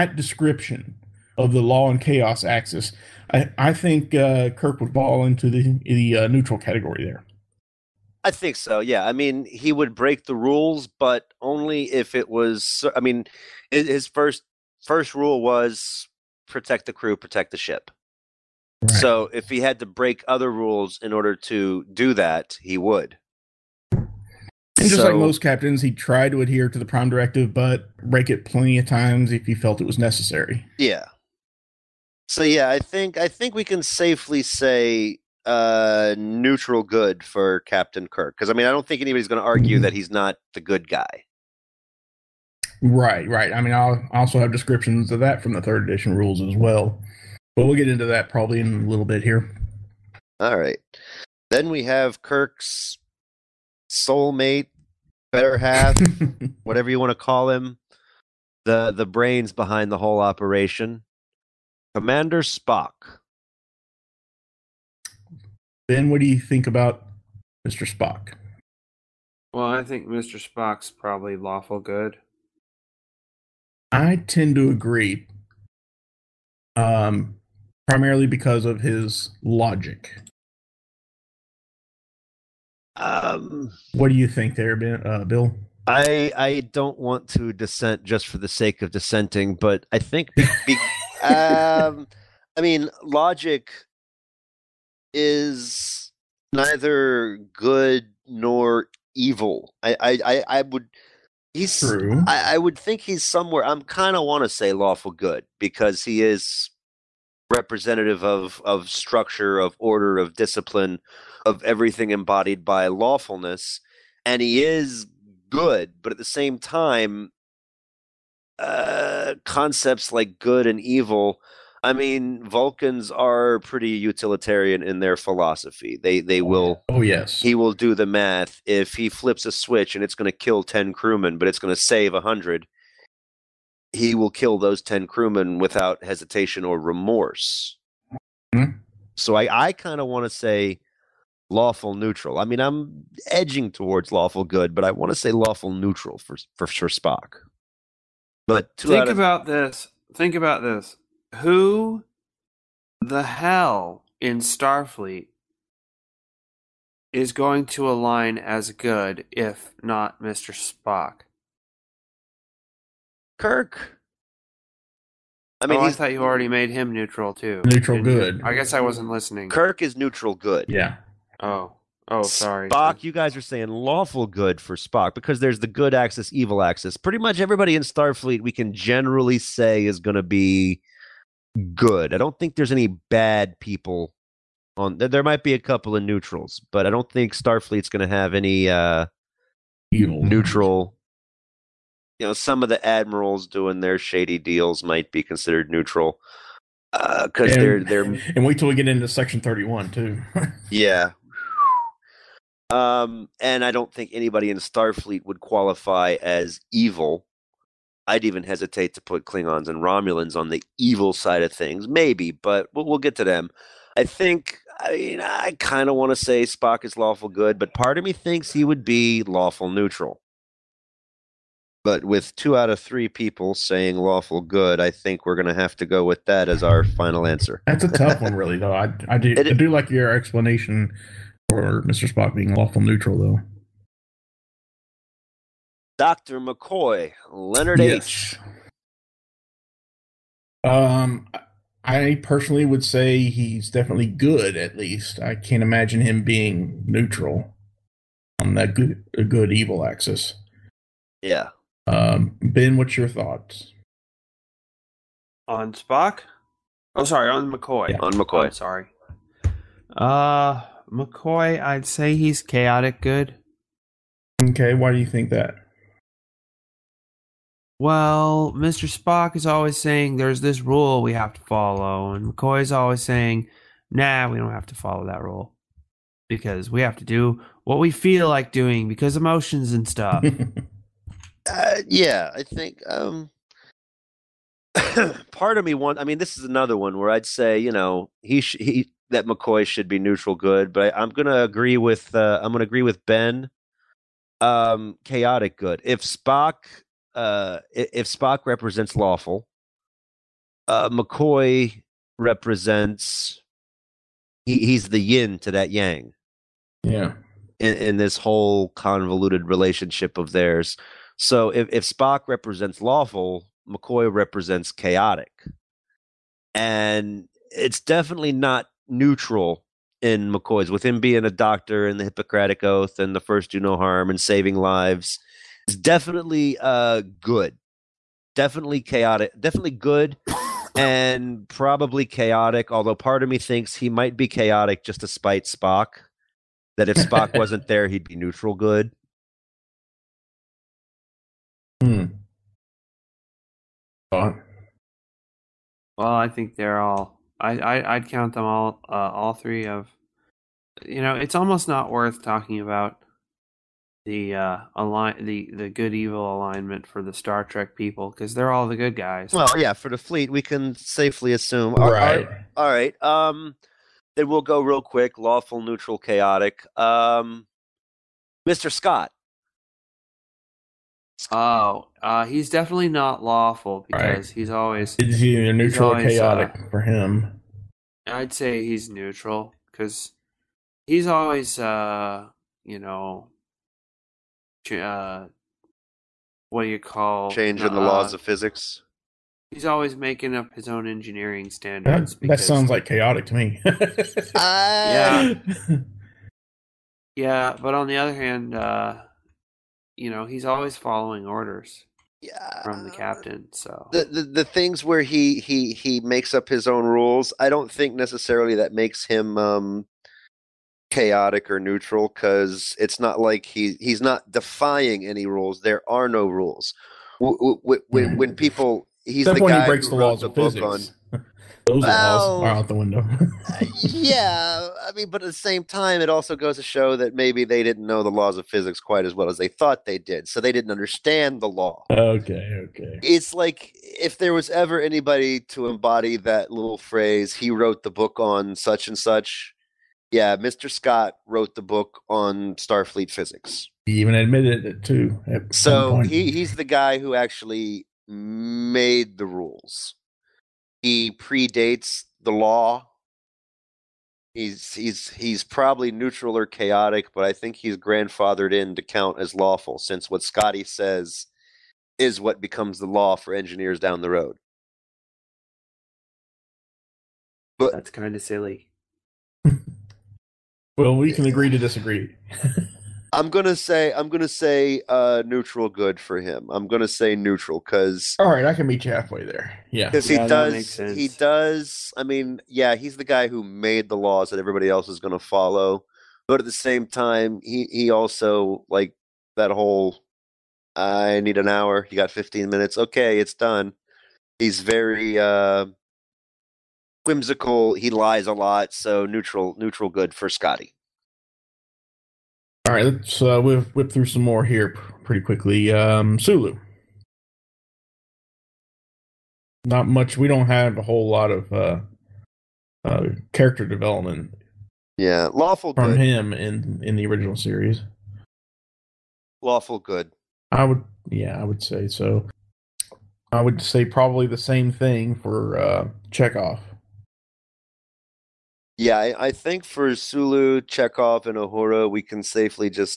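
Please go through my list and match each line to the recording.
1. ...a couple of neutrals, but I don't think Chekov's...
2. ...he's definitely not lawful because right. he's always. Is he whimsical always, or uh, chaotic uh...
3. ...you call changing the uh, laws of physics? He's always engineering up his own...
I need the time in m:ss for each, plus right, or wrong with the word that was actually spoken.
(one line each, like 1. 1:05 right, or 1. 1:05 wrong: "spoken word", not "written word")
1. 3:05 wrong: "Starfleet", not "Chekov"
2. 6:12 wrong: "neutral", not "whimsical"
3. 6:26 wrong: "making", not "engineering".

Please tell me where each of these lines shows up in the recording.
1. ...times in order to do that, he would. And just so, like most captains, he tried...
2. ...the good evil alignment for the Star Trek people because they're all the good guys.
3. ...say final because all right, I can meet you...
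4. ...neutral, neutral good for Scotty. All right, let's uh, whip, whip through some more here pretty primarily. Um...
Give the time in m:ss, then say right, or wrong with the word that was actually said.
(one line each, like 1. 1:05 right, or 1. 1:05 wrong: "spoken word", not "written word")
1. 0:20 wrong: "rules", not "times"
2. 5:55 right
3. 7:56 wrong: "neutral", not "final"
4. 8:19 wrong: "quickly", not "primarily".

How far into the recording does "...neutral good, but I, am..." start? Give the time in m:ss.
4:49.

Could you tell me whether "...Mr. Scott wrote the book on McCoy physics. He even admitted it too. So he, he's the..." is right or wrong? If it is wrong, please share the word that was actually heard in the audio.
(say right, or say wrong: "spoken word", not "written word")
wrong: "Starfleet", not "McCoy".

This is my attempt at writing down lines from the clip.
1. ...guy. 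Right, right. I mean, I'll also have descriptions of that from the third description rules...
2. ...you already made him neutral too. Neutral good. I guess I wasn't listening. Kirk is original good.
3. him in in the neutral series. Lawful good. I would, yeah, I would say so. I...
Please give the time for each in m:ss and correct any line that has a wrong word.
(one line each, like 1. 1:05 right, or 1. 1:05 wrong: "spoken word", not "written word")
1. 0:40 wrong: "edition", not "description"
2. 2:46 wrong: "neutral", not "original"
3. 8:35 wrong: "original", not "neutral".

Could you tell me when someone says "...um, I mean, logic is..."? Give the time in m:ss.
1:31.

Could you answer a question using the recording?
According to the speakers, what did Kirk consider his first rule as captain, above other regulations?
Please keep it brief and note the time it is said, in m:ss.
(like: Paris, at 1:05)
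Protect the crew, at 0:16.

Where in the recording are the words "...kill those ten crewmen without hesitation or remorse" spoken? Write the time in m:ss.
2:14.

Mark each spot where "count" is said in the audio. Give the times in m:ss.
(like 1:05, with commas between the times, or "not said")
5:48, 7:38.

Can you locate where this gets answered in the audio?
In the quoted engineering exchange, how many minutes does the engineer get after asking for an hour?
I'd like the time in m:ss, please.
8:12.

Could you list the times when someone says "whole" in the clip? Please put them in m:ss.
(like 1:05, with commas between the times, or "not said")
0:59, 5:08, 8:09, 8:30.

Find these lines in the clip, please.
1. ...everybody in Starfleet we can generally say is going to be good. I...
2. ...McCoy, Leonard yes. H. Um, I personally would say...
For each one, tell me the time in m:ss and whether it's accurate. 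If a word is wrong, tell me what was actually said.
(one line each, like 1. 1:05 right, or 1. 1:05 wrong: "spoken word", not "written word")
1. 2:57 right
2. 3:56 right.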